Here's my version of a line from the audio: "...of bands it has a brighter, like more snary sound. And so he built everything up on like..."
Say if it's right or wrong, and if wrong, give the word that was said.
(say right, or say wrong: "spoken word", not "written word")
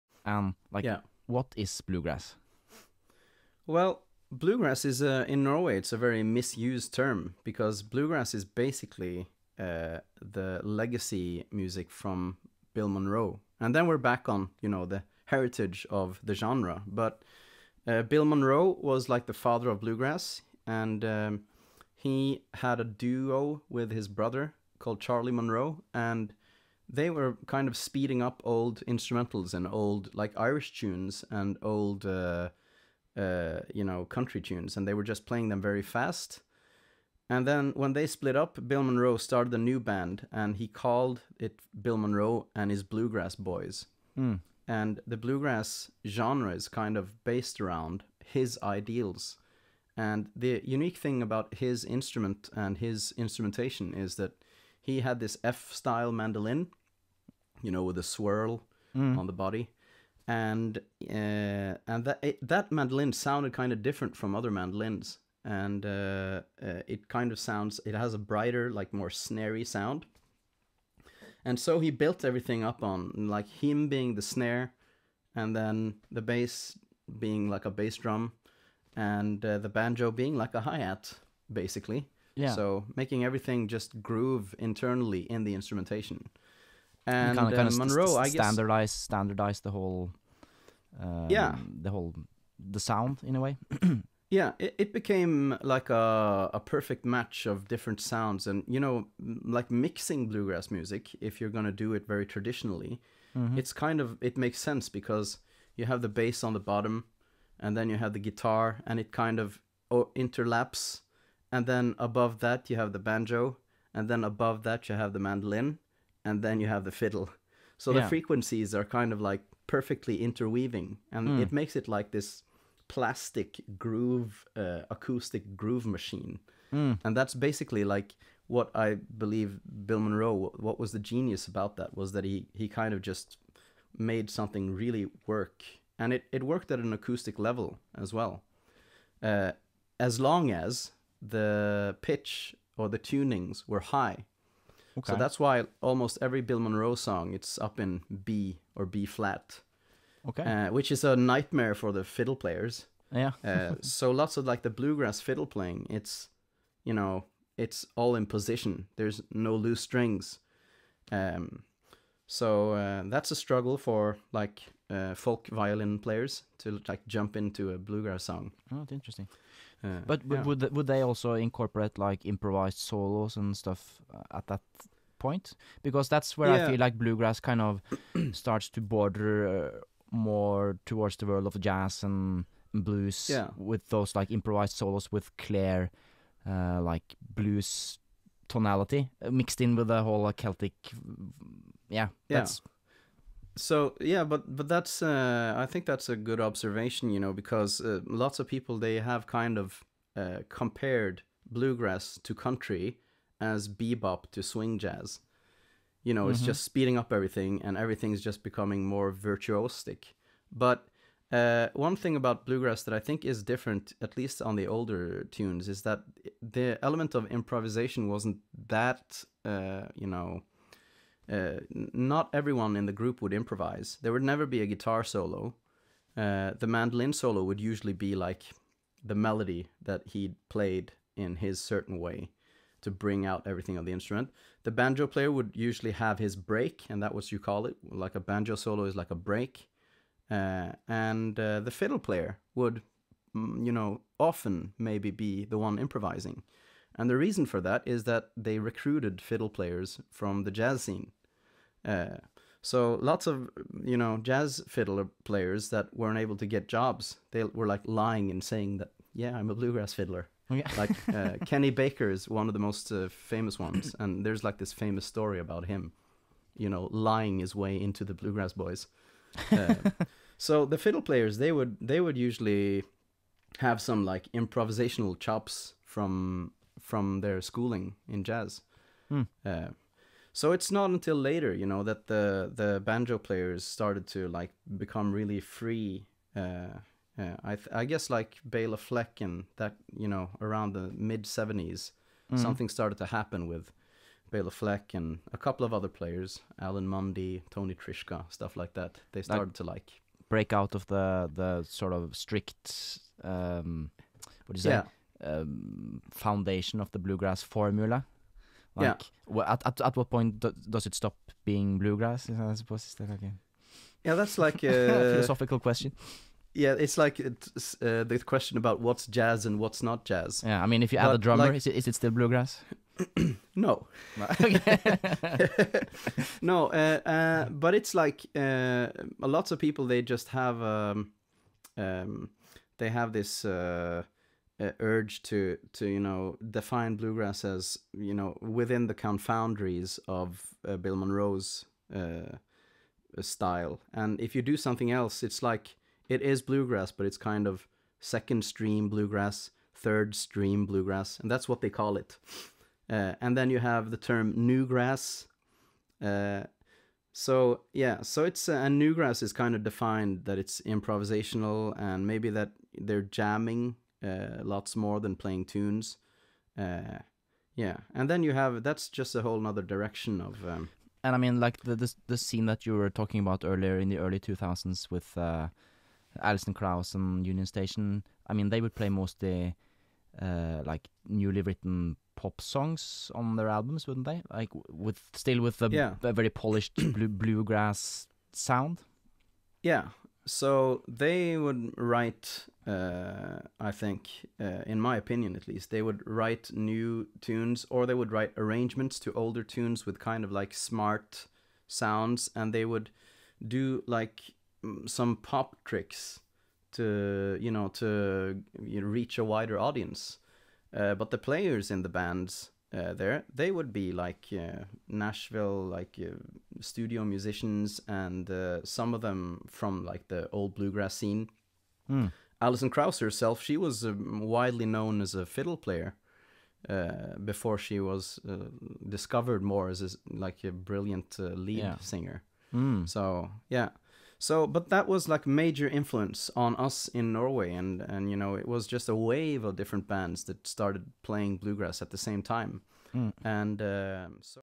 wrong: "sounds", not "bands".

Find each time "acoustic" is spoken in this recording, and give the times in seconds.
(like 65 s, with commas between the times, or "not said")
124 s, 136 s.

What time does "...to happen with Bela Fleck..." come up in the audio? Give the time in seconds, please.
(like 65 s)
292 s.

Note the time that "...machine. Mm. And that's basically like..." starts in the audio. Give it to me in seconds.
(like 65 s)
125 s.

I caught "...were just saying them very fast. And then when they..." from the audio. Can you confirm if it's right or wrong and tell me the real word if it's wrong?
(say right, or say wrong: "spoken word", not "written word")
wrong: "playing", not "saying".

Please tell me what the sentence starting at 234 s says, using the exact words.
The banjo player would usually have his break, and that was you call it.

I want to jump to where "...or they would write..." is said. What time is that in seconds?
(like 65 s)
397 s.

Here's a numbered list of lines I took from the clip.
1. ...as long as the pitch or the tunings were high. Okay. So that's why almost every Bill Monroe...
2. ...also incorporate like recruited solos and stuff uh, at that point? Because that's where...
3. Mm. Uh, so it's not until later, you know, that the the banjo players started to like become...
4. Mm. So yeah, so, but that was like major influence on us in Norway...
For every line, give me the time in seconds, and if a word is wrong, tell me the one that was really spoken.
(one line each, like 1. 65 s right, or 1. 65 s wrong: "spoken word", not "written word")
1. 139 s right
2. 171 s wrong: "improvised", not "recruited"
3. 279 s right
4. 432 s right.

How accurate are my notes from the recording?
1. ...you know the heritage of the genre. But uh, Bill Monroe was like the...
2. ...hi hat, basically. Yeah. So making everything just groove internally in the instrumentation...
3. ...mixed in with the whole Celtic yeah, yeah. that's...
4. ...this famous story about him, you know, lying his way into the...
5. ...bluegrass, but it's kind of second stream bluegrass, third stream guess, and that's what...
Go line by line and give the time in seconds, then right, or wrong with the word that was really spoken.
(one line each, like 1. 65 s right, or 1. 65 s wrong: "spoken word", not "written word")
1. 14 s right
2. 80 s right
3. 189 s right
4. 264 s right
5. 346 s wrong: "bluegrass", not "guess".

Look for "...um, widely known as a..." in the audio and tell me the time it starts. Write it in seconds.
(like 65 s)
423 s.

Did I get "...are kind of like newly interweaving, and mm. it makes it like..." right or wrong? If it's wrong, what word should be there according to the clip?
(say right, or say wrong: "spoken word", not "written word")
wrong: "perfectly", not "newly".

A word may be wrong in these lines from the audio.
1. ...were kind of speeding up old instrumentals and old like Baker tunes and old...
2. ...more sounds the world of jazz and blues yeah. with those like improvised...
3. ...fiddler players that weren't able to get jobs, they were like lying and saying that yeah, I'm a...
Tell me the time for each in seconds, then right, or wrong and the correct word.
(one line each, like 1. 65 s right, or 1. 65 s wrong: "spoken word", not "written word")
1. 27 s wrong: "Irish", not "Baker"
2. 180 s wrong: "towards", not "sounds"
3. 254 s right.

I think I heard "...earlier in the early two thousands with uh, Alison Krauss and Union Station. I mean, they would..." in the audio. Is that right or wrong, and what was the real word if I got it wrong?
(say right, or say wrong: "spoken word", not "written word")
right.